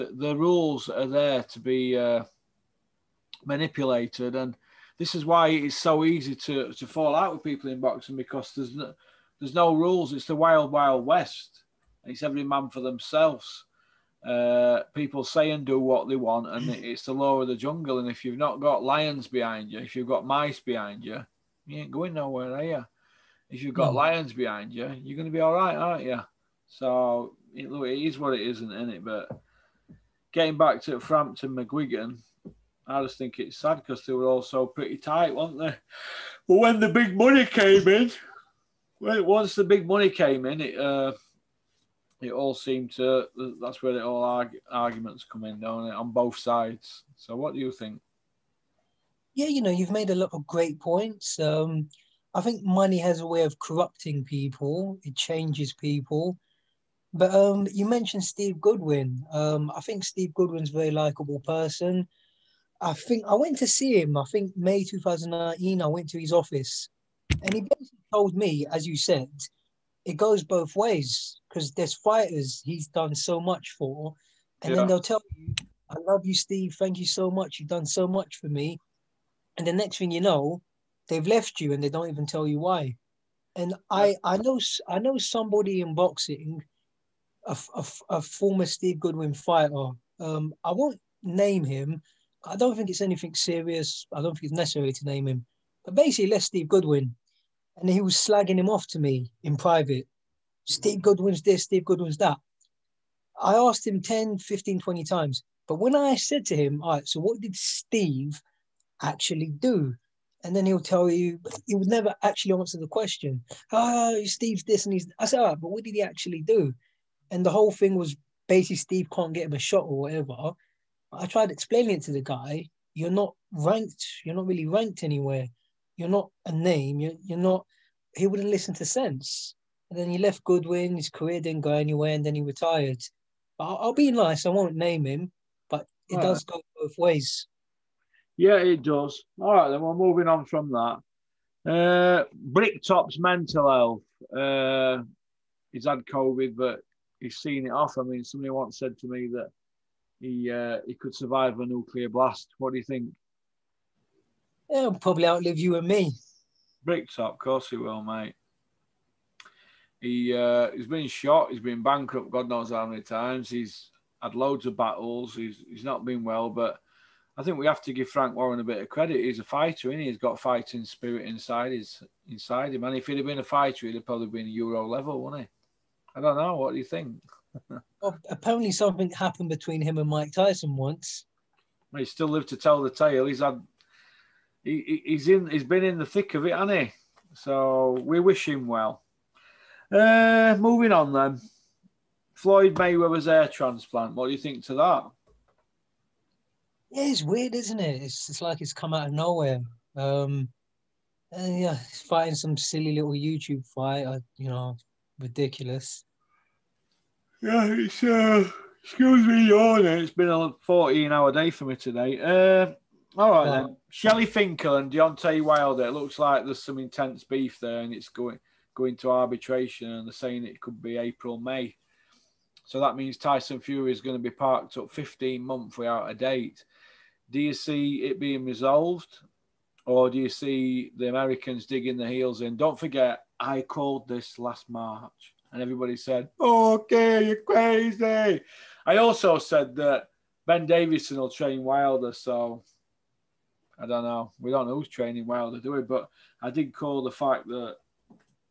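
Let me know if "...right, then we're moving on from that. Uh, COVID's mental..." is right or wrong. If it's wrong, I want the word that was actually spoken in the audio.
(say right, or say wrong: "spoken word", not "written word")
wrong: "Bricktop", not "COVID".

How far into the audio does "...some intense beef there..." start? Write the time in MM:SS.
03:36.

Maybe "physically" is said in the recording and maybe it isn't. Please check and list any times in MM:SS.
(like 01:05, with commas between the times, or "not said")
not said.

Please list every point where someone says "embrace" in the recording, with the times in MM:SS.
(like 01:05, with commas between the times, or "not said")
not said.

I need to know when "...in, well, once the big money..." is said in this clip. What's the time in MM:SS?
00:37.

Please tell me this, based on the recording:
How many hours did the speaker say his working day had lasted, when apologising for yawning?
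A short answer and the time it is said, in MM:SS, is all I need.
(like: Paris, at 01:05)
14, at 03:30.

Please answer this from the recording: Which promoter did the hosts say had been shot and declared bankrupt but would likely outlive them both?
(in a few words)
Frank Warren.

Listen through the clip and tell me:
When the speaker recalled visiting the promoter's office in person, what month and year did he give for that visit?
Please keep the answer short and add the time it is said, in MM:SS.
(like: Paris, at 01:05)
May 2019, at 01:04.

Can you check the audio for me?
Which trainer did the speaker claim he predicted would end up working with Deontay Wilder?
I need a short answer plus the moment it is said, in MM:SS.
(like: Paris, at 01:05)
Ben Davison, at 04:00.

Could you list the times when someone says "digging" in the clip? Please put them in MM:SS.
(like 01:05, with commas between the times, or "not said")
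03:51.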